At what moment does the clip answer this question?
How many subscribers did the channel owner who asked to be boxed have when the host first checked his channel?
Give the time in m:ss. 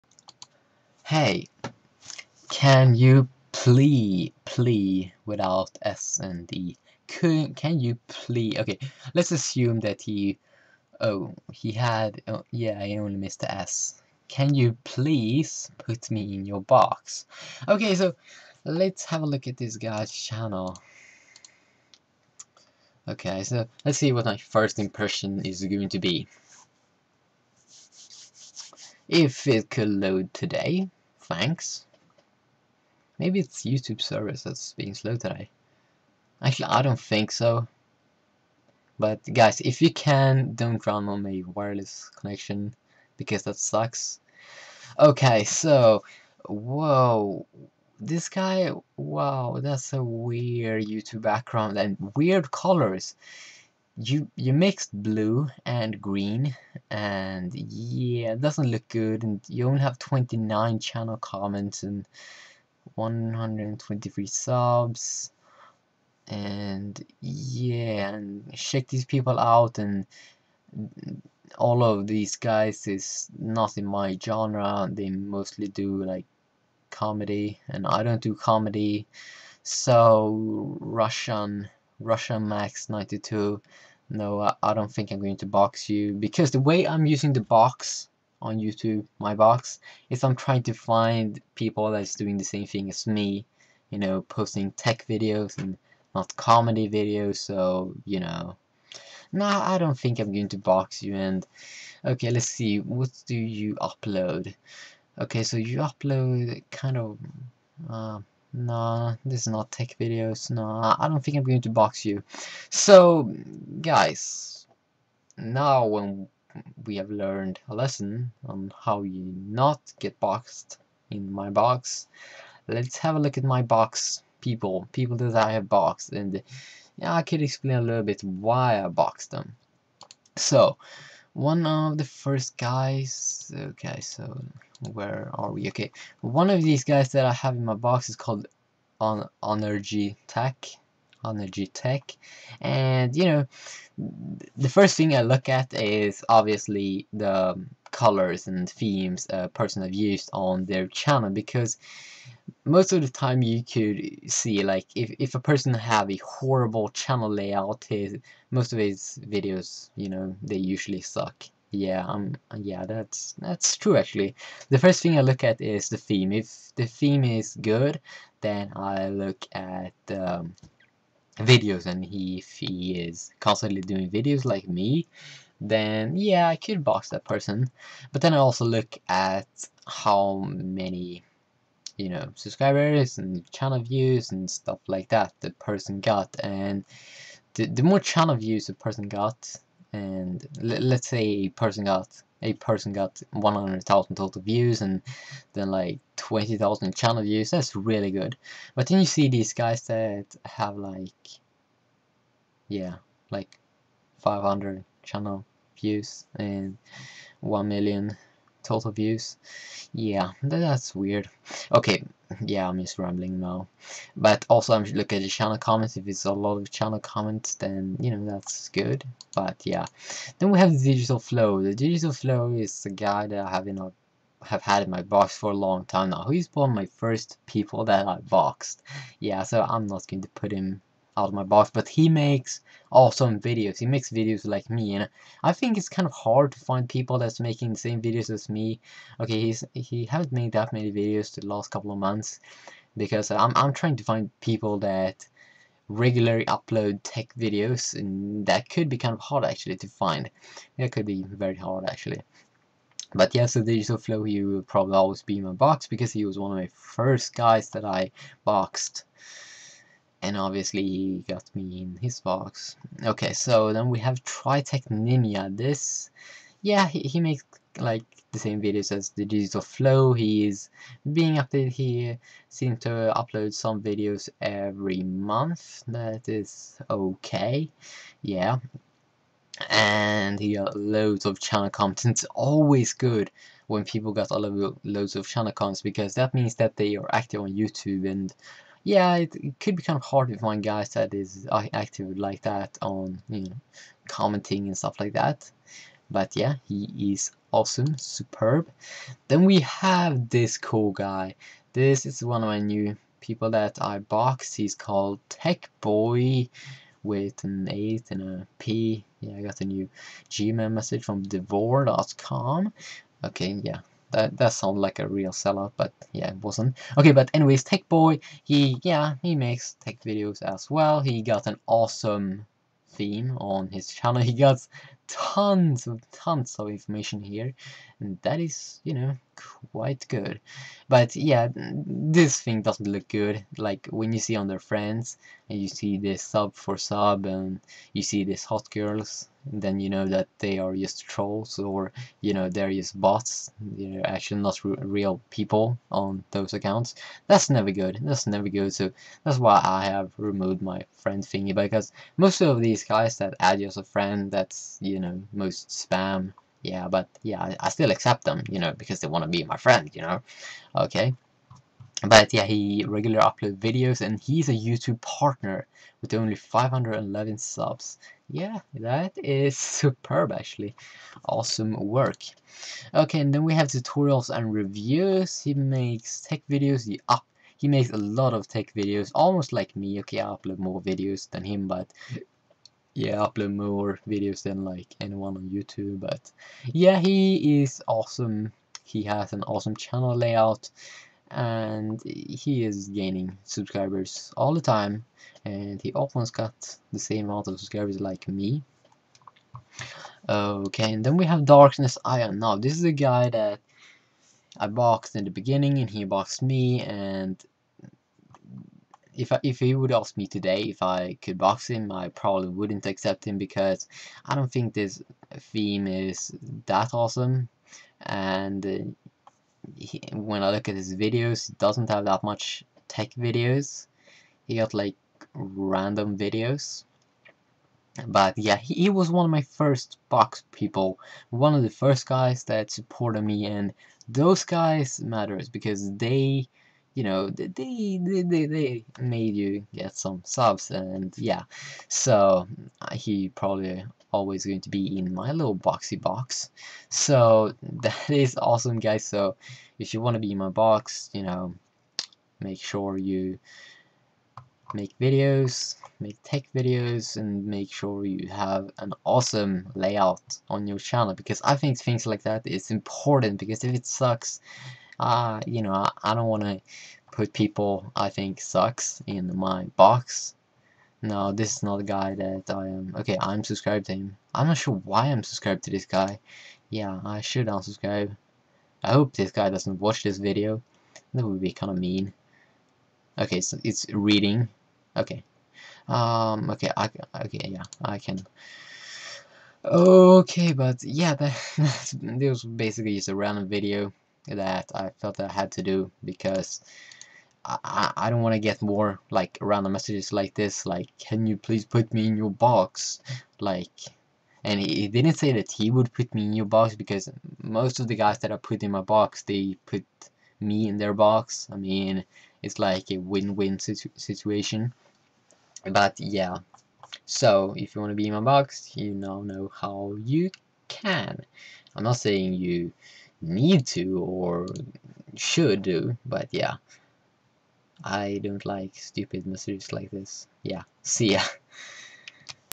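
1:02.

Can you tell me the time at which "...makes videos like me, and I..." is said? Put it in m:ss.
3:53.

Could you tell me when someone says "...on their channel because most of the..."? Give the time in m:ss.
2:30.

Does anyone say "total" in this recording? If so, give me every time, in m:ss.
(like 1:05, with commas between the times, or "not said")
3:14, 3:28.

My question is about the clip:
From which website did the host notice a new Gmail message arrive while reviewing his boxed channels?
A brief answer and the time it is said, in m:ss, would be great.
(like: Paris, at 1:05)
devore.com, at 5:11.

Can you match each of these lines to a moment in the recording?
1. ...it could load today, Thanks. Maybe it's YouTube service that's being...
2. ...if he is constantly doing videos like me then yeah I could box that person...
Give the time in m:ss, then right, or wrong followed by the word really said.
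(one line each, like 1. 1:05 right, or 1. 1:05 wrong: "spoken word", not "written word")
1. 0:29 right
2. 2:52 right.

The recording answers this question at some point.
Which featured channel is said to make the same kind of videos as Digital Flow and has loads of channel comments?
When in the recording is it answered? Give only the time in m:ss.
4:24.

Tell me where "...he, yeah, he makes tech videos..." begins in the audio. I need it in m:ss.
5:18.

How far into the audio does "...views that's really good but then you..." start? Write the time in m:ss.
3:17.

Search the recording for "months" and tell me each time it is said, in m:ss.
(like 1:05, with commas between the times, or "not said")
4:01, 4:35.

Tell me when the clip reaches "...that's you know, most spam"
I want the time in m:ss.
5:54.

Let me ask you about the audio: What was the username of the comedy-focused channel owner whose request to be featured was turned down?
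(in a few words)
Russian Max 92.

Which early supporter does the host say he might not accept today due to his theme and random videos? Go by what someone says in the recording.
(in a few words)
Darkness Iron.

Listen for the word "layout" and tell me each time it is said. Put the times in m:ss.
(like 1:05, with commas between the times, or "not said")
2:37, 6:30, 7:39.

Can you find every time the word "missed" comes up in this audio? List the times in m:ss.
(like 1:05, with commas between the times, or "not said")
0:13.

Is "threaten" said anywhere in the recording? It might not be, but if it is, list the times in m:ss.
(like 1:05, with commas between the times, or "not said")
not said.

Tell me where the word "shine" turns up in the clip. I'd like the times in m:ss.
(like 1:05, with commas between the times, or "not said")
not said.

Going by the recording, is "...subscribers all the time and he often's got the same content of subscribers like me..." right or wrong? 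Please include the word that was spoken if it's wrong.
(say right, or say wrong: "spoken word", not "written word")
wrong: "amount", not "content".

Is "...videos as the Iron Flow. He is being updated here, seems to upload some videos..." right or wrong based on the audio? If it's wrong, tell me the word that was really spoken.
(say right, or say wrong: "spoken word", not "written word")
wrong: "Digital", not "Iron".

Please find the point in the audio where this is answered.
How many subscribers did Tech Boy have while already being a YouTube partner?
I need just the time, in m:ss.
6:06.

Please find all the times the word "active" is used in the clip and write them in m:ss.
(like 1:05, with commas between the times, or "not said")
4:47, 4:51.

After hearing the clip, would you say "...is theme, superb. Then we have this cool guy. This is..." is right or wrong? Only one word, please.
wrong.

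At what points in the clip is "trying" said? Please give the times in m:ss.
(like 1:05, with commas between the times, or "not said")
1:30, 4:03.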